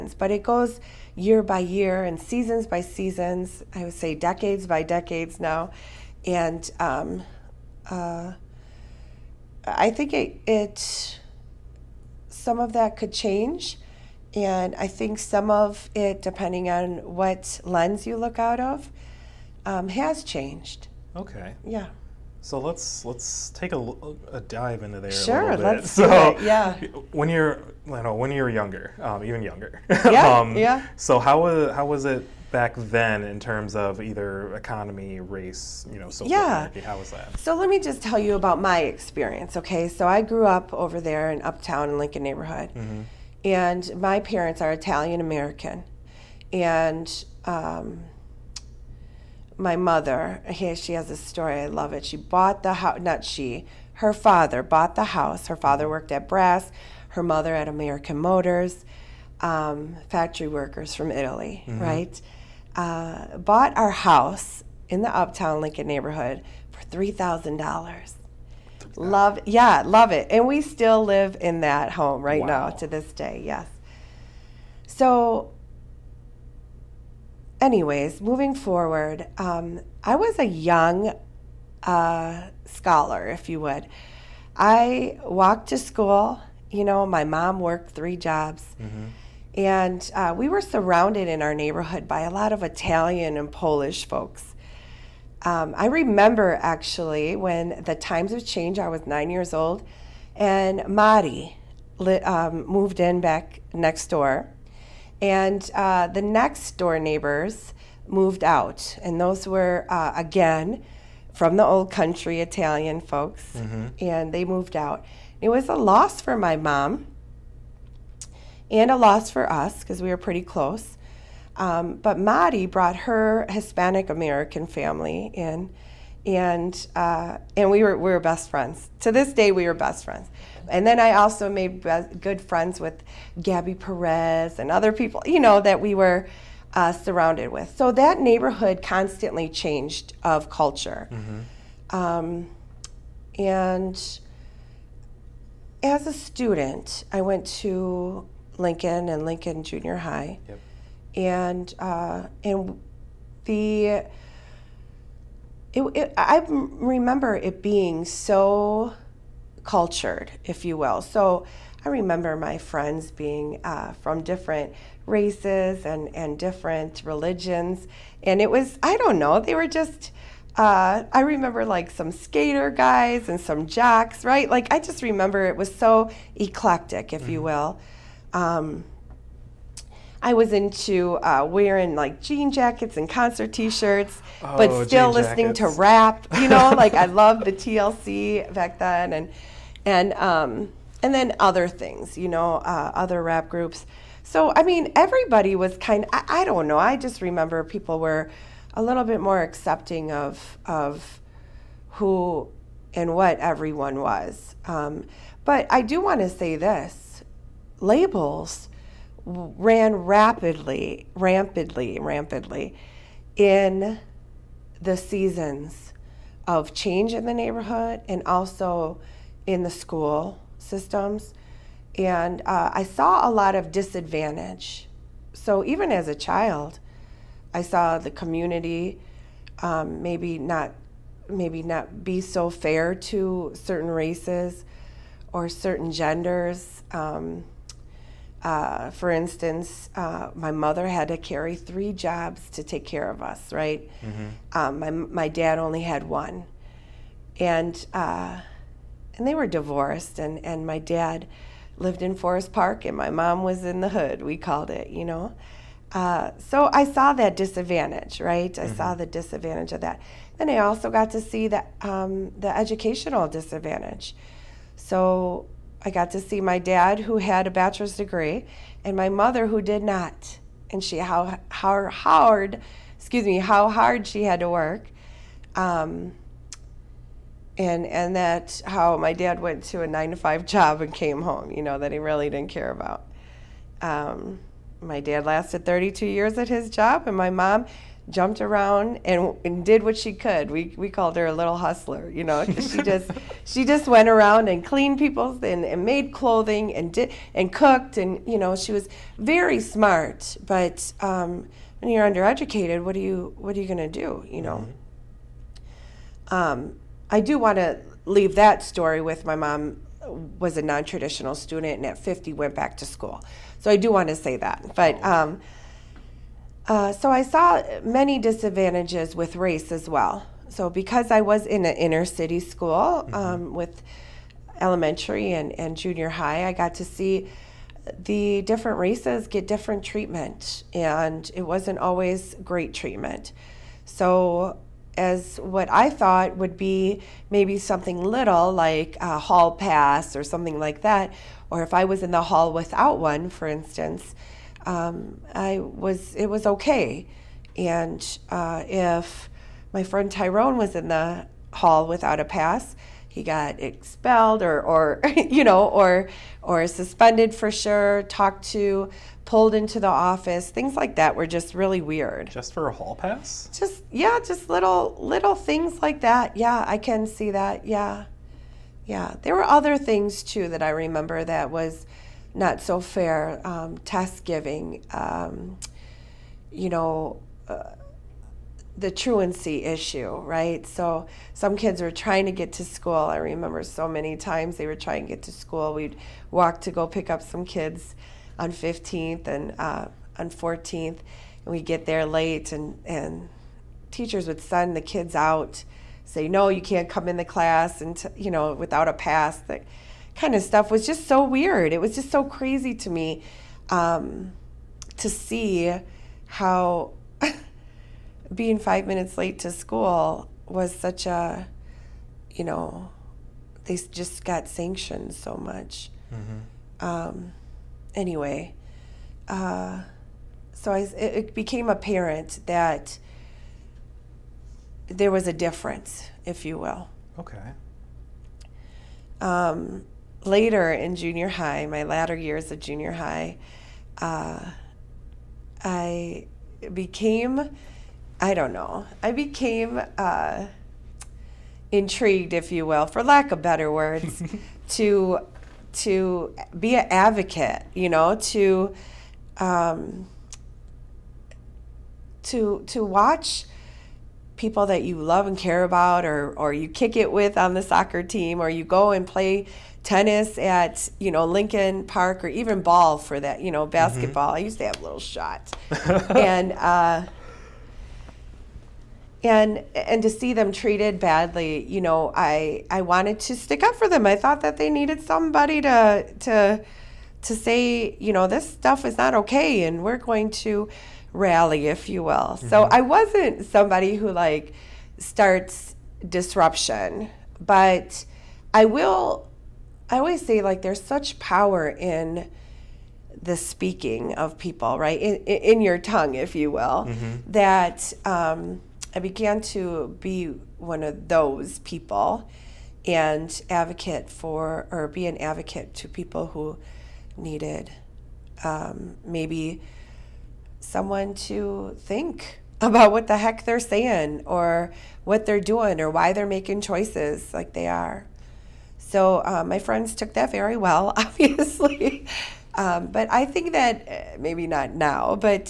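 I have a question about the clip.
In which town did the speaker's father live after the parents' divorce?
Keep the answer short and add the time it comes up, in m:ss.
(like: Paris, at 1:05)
Forest Park, at 4:12.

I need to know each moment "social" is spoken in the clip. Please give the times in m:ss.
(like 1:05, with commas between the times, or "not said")
0:36.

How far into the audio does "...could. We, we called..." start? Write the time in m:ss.
4:50.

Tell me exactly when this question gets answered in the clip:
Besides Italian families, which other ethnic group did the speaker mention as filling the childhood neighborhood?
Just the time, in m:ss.
1:33.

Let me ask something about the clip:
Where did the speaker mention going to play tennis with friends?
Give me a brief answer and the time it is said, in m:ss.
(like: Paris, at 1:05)
Lincoln Park, at 7:41.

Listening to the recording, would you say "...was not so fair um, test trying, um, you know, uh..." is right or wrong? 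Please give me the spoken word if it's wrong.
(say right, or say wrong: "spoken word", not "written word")
wrong: "giving", not "trying".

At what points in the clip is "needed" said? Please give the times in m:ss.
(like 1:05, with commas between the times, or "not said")
7:54, 8:27.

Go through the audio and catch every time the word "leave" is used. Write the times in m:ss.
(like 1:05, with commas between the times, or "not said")
5:08.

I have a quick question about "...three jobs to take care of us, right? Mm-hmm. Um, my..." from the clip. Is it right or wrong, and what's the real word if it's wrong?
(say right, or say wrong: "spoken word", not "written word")
right.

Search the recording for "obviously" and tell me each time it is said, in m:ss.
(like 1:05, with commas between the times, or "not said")
8:40.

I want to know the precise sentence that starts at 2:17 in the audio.
So that neighborhood constantly changed of culture, mm-hmm.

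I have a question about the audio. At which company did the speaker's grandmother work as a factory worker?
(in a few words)
American Motors.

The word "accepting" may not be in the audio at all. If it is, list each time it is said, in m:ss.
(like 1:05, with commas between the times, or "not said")
3:19.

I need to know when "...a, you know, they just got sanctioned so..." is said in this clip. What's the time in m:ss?
6:51.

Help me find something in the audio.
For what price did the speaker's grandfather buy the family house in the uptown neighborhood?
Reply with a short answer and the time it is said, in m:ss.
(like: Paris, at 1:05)
$3,000, at 1:06.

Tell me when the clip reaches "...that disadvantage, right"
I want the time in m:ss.
4:17.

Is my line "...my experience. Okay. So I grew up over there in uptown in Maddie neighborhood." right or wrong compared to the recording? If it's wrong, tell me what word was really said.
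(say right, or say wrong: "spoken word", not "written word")
wrong: "Lincoln", not "Maddie".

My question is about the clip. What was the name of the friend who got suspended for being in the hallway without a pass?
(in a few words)
Tyrone.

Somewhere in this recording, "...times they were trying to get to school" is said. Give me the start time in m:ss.
6:24.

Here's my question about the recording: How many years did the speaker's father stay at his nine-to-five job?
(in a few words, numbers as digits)
32.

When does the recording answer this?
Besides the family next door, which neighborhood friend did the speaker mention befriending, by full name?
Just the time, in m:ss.
2:13.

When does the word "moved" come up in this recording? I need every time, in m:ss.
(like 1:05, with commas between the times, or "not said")
1:42, 1:48, 1:54.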